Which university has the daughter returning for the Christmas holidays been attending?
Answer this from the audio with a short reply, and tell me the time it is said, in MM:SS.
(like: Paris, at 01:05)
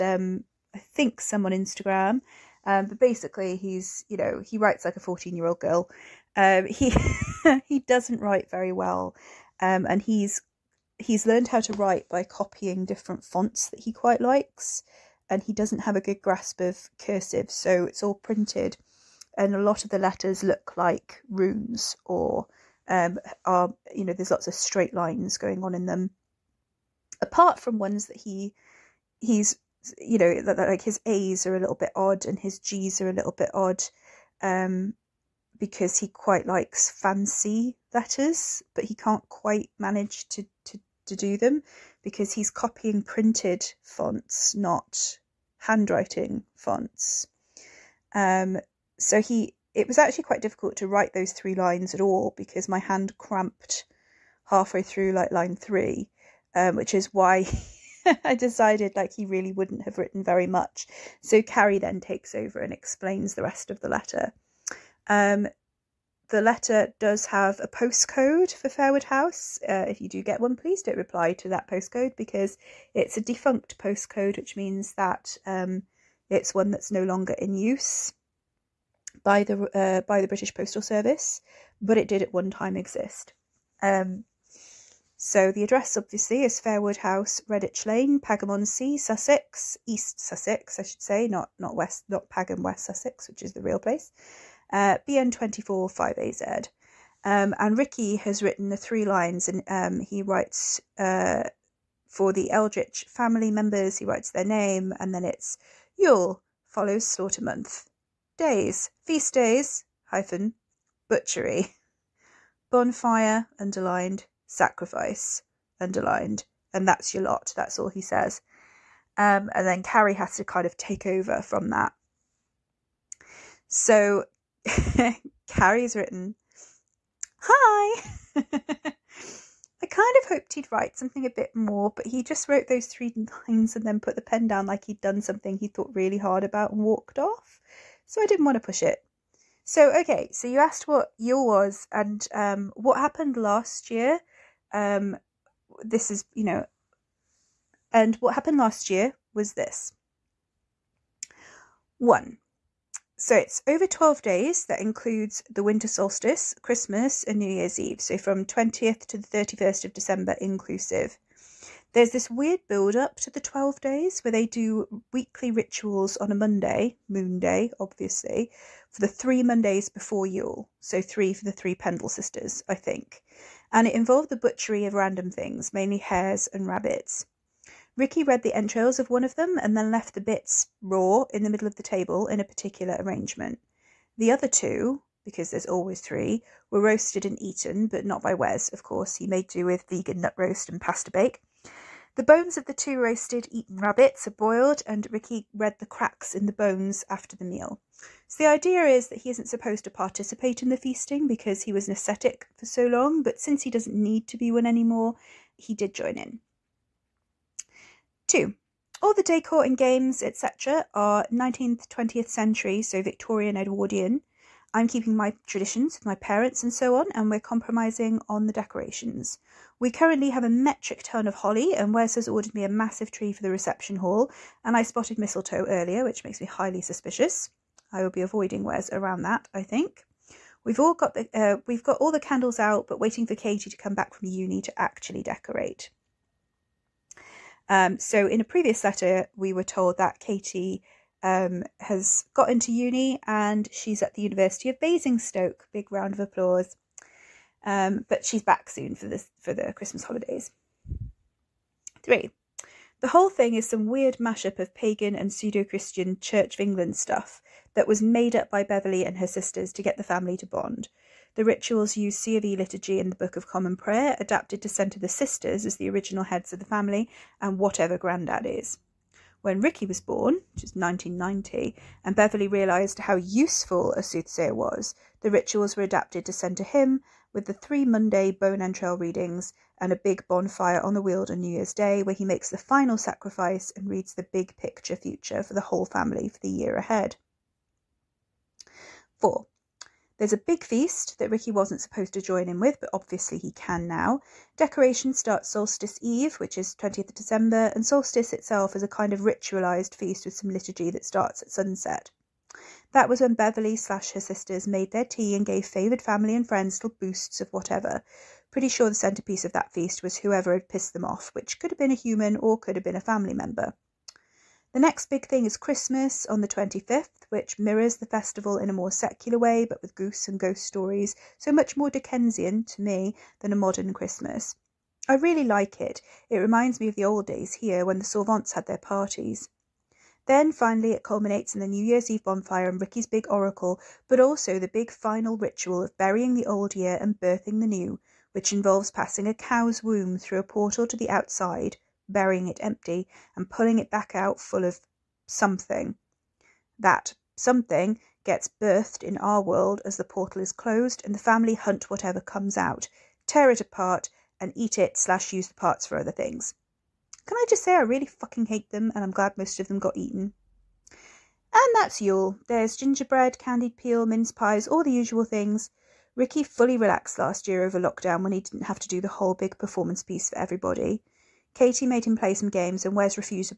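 University of Basingstoke, at 04:04.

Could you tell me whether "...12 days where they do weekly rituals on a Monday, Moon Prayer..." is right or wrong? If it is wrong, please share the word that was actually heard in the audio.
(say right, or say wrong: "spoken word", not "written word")
wrong: "Day", not "Prayer".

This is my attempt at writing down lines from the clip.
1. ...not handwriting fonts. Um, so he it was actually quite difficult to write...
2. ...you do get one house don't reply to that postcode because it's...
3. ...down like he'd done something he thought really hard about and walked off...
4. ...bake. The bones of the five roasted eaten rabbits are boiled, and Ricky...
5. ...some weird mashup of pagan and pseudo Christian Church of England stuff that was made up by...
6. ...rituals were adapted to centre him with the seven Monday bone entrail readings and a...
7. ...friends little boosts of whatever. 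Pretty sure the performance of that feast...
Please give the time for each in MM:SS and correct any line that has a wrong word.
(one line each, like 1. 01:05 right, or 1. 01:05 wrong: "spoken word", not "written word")
1. 00:44 right
2. 01:10 wrong: "please", not "house"
3. 02:14 right
4. 03:11 wrong: "two", not "five"
5. 04:13 right
6. 04:35 wrong: "three", not "seven"
7. 05:06 wrong: "centrepiece", not "performance".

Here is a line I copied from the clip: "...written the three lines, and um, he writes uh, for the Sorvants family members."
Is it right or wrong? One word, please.
wrong.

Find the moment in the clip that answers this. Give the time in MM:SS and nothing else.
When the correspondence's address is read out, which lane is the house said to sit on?
01:27.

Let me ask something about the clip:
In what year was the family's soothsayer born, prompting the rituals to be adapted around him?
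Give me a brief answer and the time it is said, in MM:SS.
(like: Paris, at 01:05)
1990, at 04:30.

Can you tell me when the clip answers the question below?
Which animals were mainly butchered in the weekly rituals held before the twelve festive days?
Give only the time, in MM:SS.
02:55.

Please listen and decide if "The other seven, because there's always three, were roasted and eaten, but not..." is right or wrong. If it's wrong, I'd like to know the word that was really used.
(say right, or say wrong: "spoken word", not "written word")
wrong: "two", not "seven".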